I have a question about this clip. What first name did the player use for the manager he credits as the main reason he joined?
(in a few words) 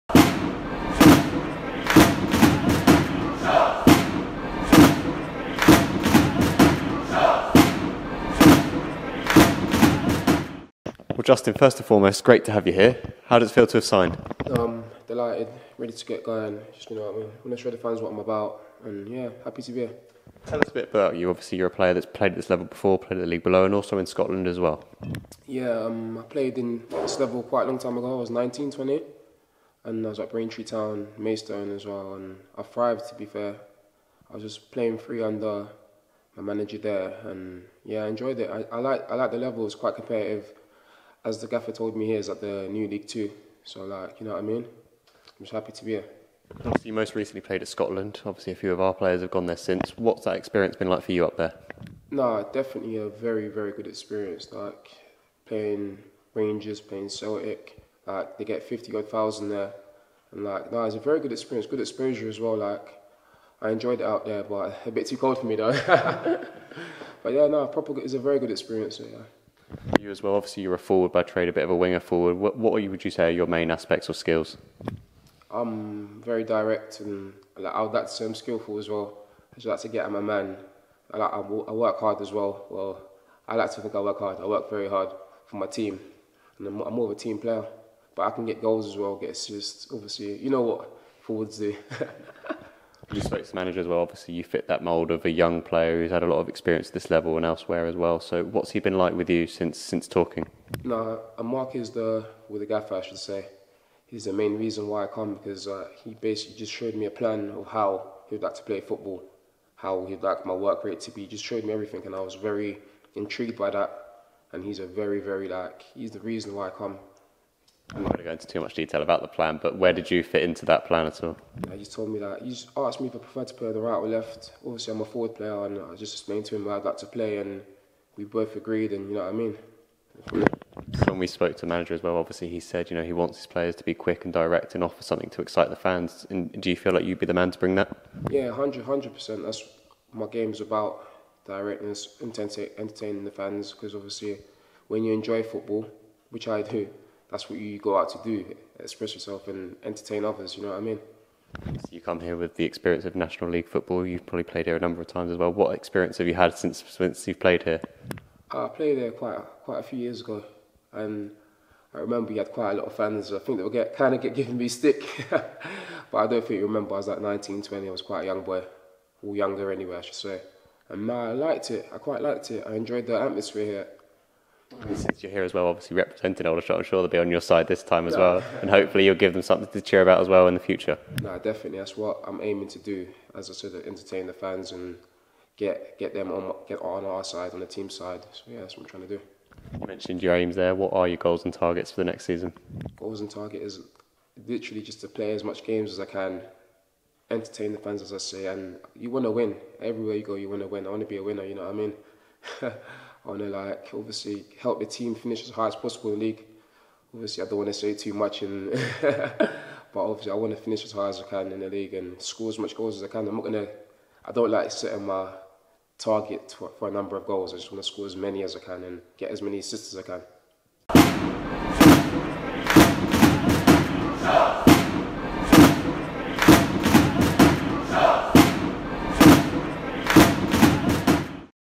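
Mark.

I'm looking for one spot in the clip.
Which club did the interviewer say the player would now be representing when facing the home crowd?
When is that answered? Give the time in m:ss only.
2:56.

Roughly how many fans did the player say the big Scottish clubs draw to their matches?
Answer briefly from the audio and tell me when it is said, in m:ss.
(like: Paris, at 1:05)
fifty odd thousand, at 0:58.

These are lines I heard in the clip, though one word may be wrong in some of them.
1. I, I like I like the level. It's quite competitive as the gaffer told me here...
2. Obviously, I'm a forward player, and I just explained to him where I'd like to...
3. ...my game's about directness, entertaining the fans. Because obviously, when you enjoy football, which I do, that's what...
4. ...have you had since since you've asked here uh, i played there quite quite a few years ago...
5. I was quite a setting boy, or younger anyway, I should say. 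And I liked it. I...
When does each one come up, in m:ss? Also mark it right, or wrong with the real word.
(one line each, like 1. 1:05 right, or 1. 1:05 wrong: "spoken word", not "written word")
1. 0:38 right
2. 2:04 right
3. 2:20 right
4. 2:36 wrong: "played", not "asked"
5. 2:47 wrong: "young", not "setting".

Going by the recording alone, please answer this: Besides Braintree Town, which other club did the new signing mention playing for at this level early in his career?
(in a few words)
Maidstone.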